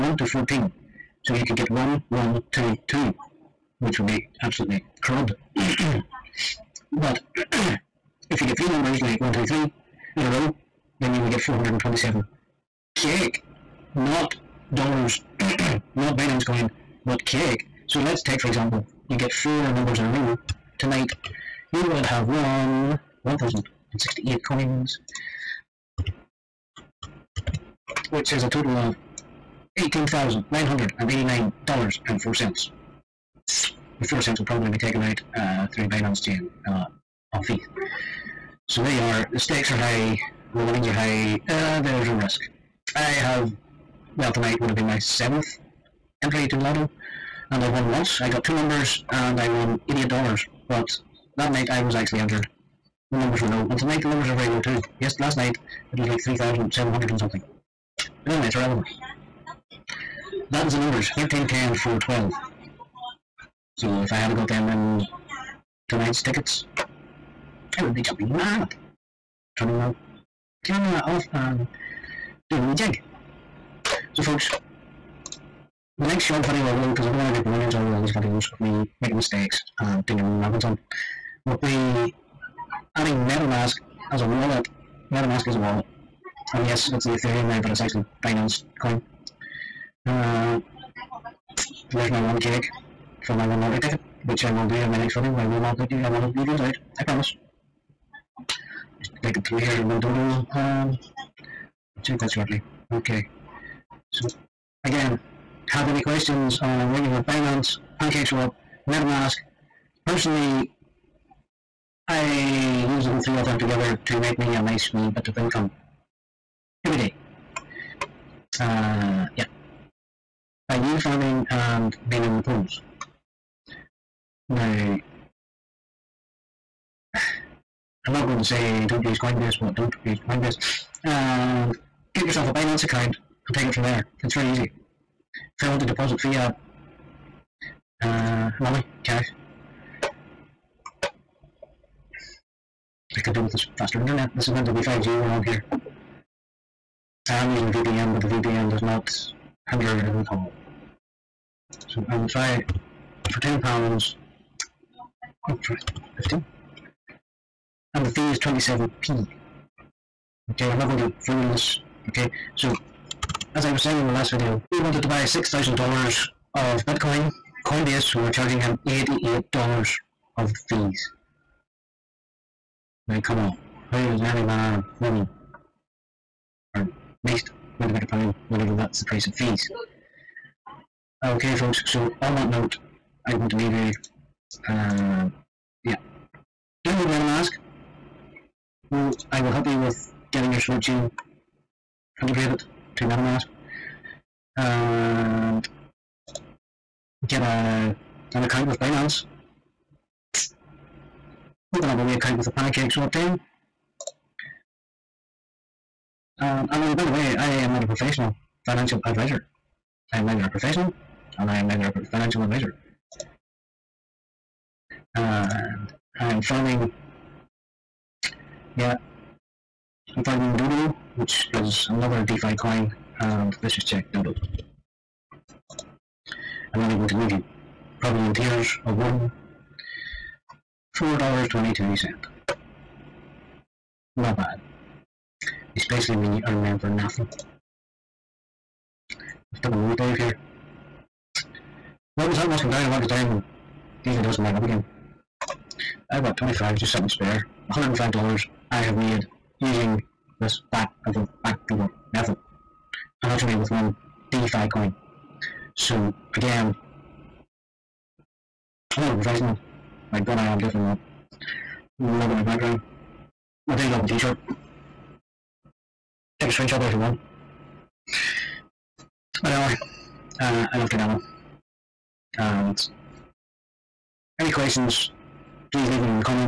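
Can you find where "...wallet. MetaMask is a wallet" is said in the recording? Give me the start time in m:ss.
1:24.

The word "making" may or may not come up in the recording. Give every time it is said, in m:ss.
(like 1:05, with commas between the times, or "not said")
1:19.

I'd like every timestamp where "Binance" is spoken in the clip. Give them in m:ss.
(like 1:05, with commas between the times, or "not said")
0:16, 0:35, 1:28, 1:47, 2:12, 3:18.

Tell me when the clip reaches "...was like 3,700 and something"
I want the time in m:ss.
0:55.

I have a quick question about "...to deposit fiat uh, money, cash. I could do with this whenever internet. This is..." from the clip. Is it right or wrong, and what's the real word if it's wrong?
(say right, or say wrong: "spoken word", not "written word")
wrong: "faster", not "whenever".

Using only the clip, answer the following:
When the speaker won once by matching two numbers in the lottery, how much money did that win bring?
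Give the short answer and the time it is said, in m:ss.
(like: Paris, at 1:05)
$88, at 0:49.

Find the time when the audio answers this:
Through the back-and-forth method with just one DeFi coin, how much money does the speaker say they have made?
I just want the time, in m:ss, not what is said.
4:07.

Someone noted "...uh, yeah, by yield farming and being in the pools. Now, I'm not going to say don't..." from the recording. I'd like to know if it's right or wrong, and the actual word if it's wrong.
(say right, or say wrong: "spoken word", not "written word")
right.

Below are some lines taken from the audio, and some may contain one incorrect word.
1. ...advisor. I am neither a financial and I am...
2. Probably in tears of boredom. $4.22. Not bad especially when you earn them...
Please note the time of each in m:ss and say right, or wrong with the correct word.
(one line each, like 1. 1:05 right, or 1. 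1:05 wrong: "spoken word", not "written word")
1. 3:29 wrong: "professional", not "financial"
2. 3:47 right.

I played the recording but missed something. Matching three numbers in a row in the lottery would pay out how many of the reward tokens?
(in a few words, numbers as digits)
427 cake.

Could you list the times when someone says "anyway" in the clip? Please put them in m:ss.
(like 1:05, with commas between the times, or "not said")
0:58, 4:29.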